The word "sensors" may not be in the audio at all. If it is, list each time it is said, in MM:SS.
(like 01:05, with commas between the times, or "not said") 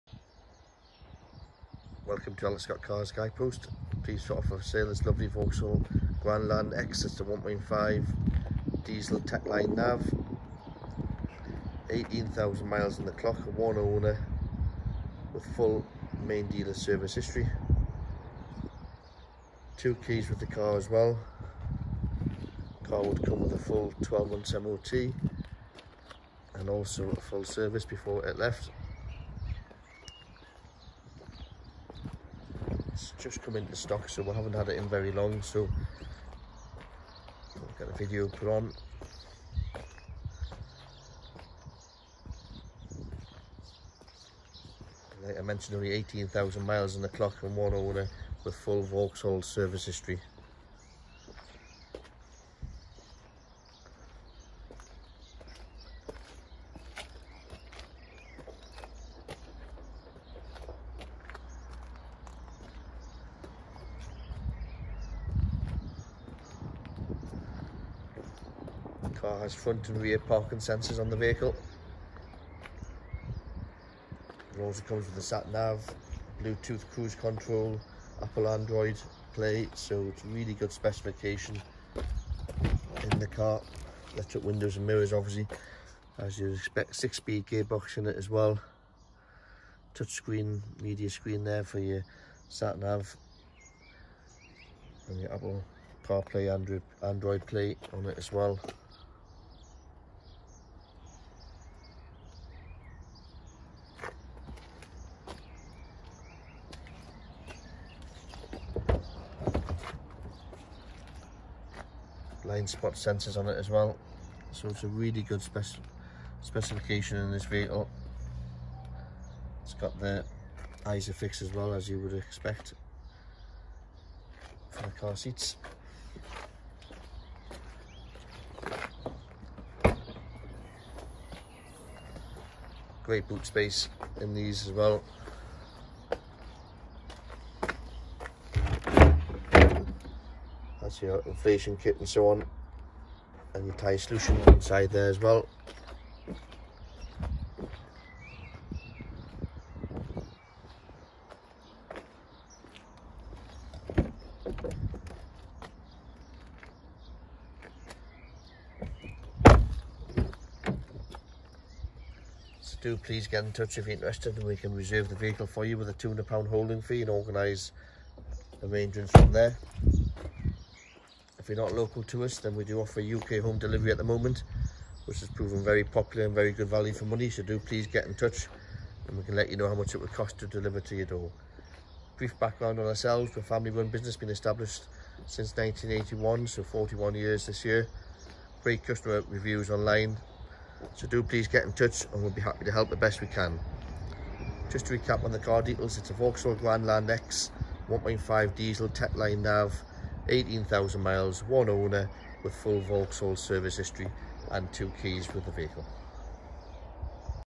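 01:10, 01:52.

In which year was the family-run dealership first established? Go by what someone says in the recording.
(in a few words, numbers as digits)
1981.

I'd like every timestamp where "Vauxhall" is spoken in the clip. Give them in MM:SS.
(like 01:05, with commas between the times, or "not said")
00:05, 00:48, 03:16, 03:22.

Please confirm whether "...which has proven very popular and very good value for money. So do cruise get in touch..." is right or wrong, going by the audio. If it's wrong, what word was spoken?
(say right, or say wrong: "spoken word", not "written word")
wrong: "please", not "cruise".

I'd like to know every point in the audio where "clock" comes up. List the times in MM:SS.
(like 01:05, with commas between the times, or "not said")
00:13, 00:47.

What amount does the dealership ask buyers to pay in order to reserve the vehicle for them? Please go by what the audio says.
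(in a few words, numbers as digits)
£200.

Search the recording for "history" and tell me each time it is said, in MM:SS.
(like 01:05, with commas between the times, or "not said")
00:17, 00:49, 03:23.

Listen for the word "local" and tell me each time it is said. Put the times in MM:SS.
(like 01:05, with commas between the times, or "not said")
02:51.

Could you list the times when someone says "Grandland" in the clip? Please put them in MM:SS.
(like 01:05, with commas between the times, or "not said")
00:06, 03:16.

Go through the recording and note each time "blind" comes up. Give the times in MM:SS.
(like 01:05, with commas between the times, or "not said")
01:52.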